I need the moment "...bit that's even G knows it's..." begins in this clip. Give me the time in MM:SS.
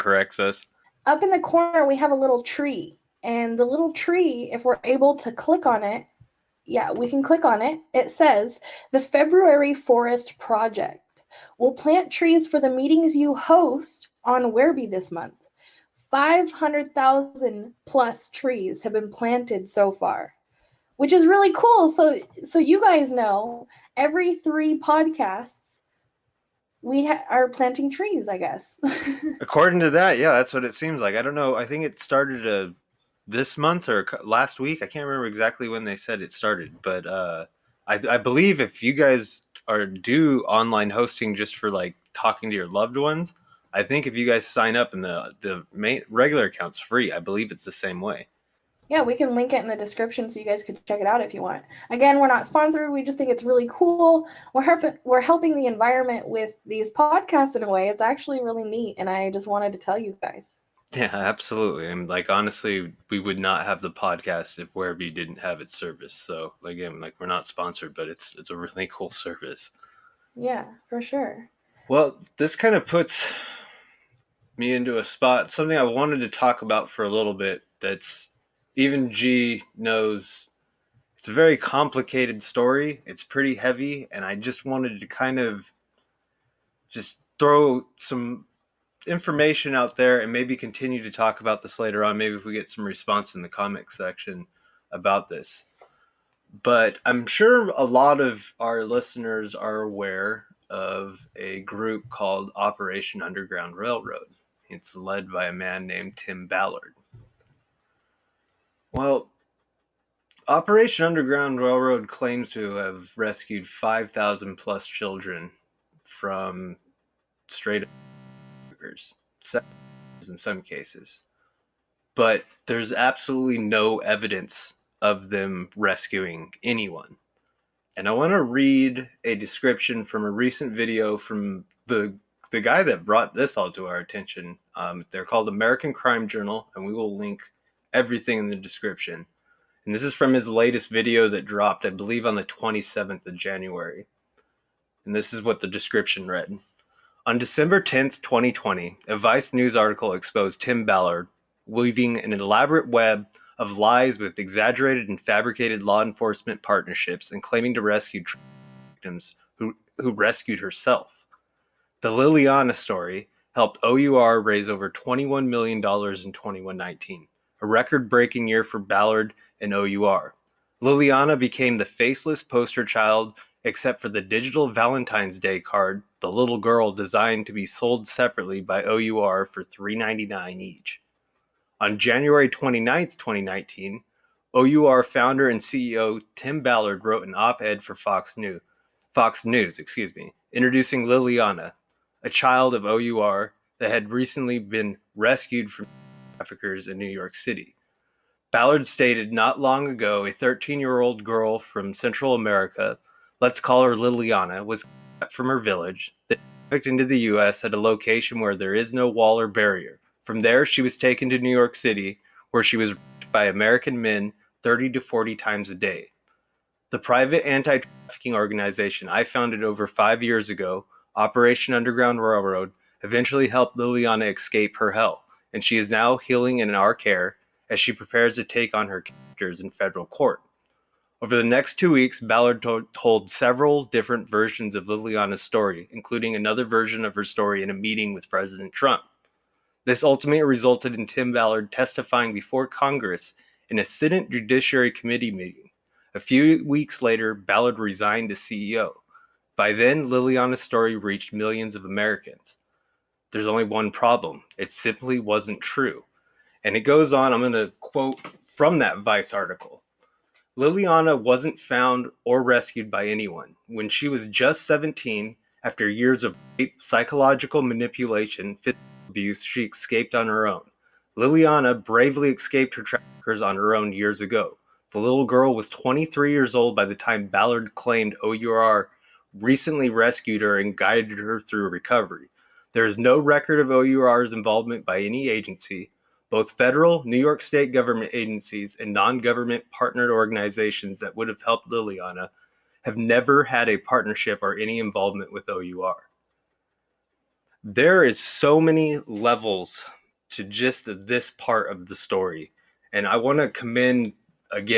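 01:17.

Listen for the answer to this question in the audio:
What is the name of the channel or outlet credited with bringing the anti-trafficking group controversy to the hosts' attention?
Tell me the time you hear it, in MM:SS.
02:15.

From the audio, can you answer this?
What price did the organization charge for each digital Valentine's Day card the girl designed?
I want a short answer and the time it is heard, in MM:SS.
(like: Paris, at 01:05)
$3.99, at 02:59.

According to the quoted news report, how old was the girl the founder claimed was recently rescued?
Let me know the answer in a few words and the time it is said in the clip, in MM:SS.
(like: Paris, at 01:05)
23, at 04:35.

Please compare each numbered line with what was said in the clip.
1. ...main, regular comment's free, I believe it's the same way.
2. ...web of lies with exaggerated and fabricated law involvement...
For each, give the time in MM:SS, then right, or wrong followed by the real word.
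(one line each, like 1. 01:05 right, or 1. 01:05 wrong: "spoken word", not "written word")
1. 00:45 wrong: "account", not "comment"
2. 02:32 wrong: "enforcement", not "involvement".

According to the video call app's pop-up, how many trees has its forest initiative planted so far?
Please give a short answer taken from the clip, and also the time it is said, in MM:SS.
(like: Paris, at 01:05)
500,000 plus, at 00:16.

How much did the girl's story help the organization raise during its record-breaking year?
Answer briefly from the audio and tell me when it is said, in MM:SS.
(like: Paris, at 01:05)
$21 million, at 02:44.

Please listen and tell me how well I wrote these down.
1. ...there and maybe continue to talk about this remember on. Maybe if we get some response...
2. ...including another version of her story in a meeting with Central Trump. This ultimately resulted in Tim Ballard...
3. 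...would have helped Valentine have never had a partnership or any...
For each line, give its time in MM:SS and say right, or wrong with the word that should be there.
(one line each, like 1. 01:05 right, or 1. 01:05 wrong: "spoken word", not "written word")
1. 01:29 wrong: "later", not "remember"
2. 03:55 wrong: "President", not "Central"
3. 04:51 wrong: "Liliana", not "Valentine".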